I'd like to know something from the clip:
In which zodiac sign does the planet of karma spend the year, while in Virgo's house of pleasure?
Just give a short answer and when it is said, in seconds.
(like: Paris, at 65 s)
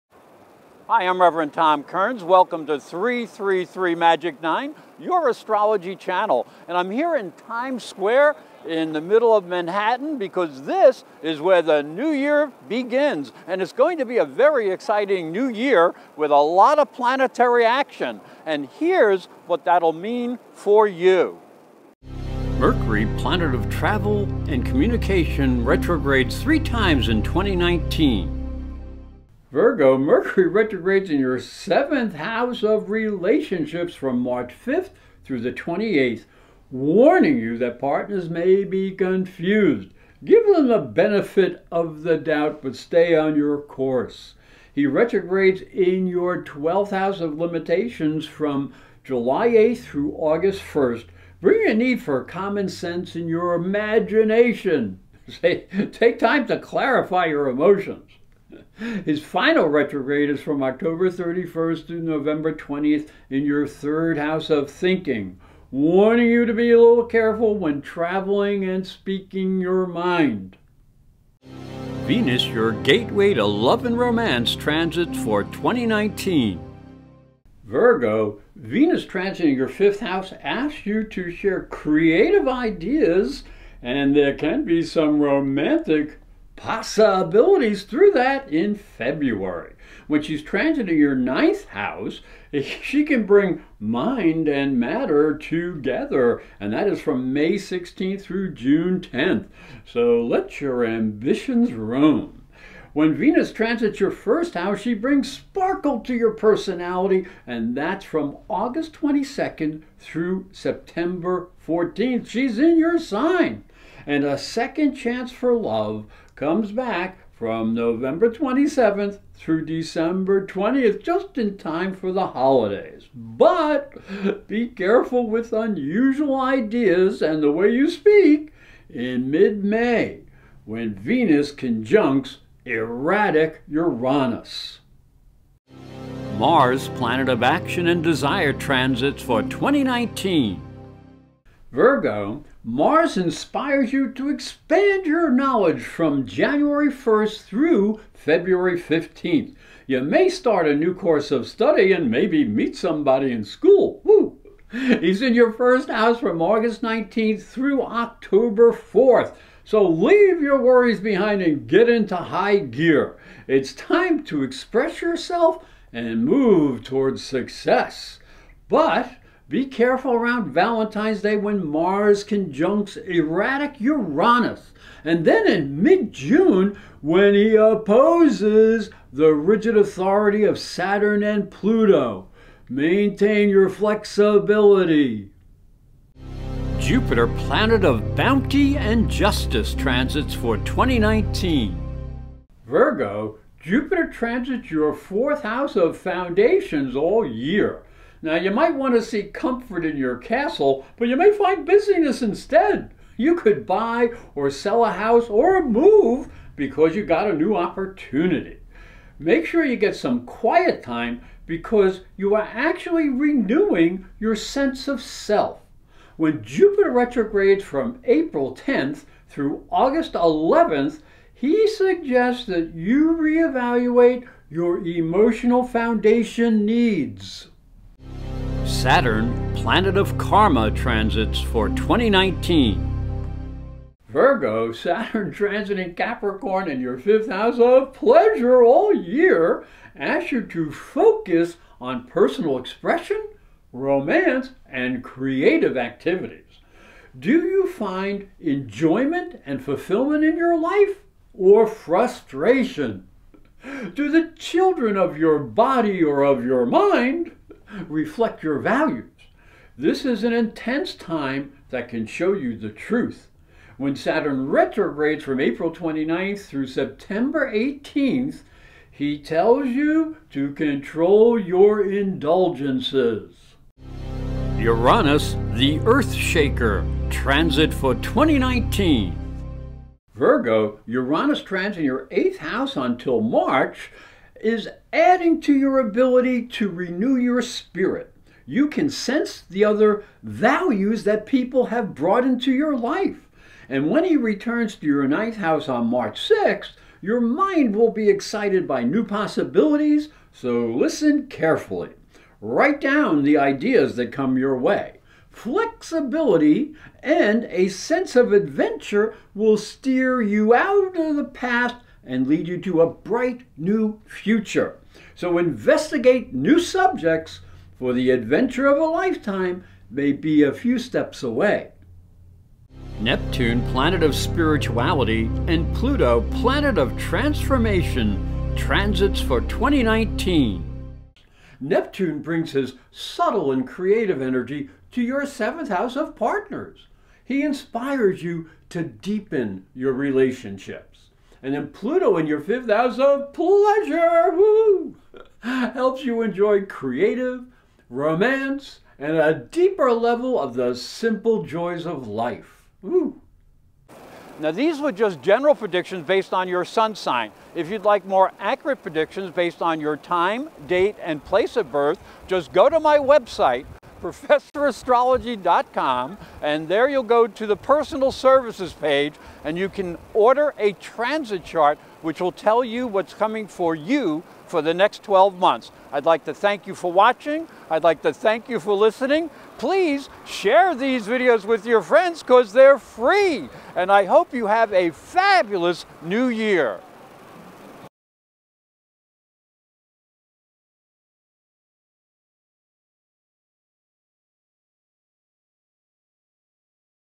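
Capricorn, at 235 s.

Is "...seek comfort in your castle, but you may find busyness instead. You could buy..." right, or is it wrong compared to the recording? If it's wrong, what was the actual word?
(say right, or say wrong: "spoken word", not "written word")
right.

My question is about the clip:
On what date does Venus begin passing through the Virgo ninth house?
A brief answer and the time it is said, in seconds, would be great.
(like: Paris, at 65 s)
May 16th, at 97 s.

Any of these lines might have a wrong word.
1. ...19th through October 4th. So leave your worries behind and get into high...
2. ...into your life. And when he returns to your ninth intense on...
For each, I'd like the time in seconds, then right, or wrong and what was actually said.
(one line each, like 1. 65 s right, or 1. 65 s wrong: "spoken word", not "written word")
1. 156 s right
2. 292 s wrong: "house", not "intense".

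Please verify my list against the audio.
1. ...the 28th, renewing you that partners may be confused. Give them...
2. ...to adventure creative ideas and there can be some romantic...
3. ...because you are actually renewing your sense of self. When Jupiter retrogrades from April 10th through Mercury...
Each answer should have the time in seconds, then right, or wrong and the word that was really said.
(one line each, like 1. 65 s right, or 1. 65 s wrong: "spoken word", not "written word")
1. 35 s wrong: "warning", not "renewing"
2. 81 s wrong: "share", not "adventure"
3. 211 s wrong: "August", not "Mercury".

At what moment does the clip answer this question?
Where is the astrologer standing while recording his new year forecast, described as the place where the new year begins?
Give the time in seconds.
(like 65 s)
7 s.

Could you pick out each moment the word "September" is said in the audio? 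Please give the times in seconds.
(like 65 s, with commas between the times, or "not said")
110 s, 266 s.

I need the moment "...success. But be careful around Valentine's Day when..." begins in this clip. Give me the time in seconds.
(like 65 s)
167 s.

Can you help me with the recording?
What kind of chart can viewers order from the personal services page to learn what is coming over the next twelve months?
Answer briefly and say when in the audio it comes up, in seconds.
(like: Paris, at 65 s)
transit chart, at 370 s.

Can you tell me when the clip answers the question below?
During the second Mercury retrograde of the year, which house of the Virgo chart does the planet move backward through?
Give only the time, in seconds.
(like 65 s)
46 s.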